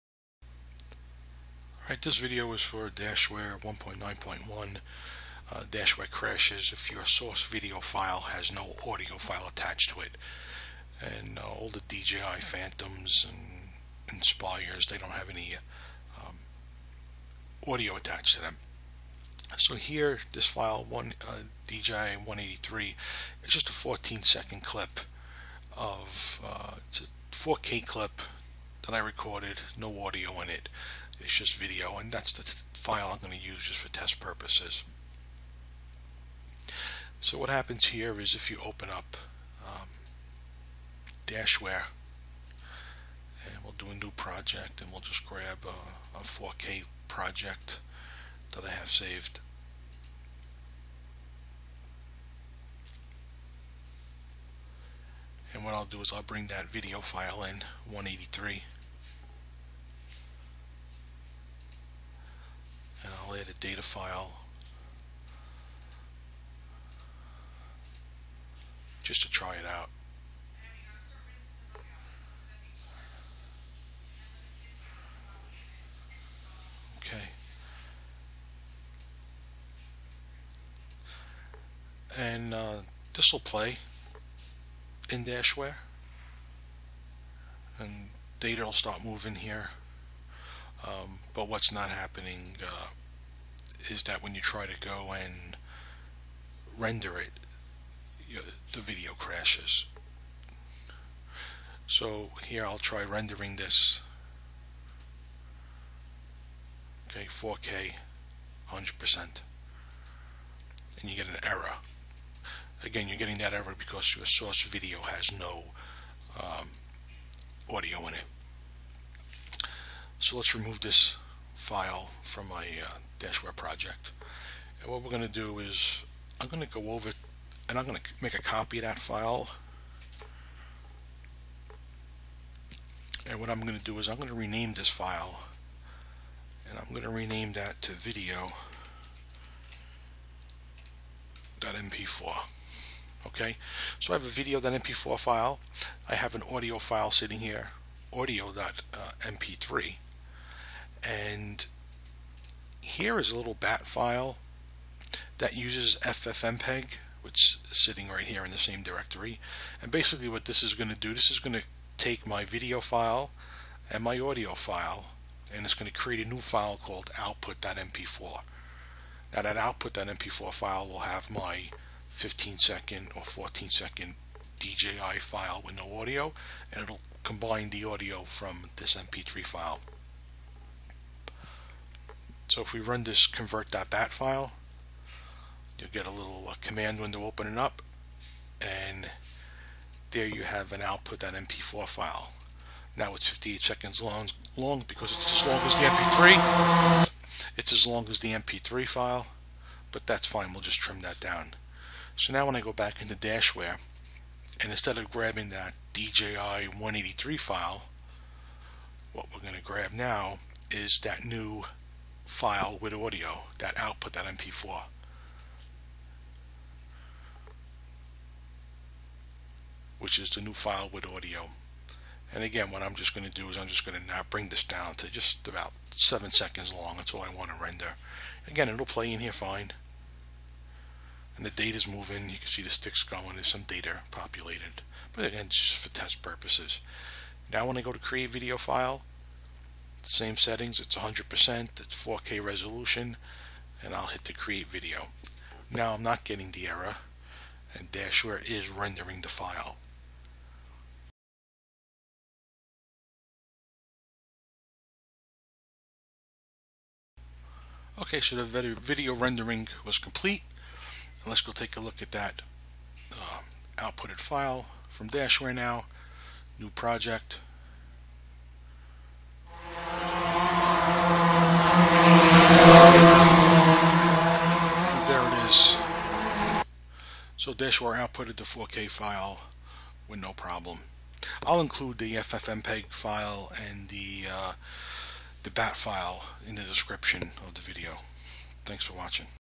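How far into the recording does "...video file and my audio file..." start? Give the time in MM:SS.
02:42.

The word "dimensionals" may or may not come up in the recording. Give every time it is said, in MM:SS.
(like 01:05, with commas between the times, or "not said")
not said.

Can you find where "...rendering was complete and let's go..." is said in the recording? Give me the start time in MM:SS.
04:19.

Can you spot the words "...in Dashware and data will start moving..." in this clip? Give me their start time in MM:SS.
01:25.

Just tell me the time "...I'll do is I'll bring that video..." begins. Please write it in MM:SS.
00:55.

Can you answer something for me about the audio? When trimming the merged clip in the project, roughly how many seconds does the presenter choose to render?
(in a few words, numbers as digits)
7.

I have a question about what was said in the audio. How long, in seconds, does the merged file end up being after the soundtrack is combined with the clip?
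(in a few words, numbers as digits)
58.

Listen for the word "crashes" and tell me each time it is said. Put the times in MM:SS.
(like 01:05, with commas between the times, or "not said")
00:06, 01:39.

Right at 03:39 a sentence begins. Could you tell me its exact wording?
which is the new file with audio.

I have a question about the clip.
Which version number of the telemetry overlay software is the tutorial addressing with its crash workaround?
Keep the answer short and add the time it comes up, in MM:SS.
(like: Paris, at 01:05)
1.9.1, at 00:03.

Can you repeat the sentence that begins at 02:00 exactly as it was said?
So let's remove this file from my uh, Dashware project.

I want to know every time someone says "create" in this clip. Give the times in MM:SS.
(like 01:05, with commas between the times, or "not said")
02:45, 03:57, 04:04.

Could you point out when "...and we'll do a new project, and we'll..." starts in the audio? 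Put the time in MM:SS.
00:43.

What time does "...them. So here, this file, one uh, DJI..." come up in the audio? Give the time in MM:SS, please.
00:18.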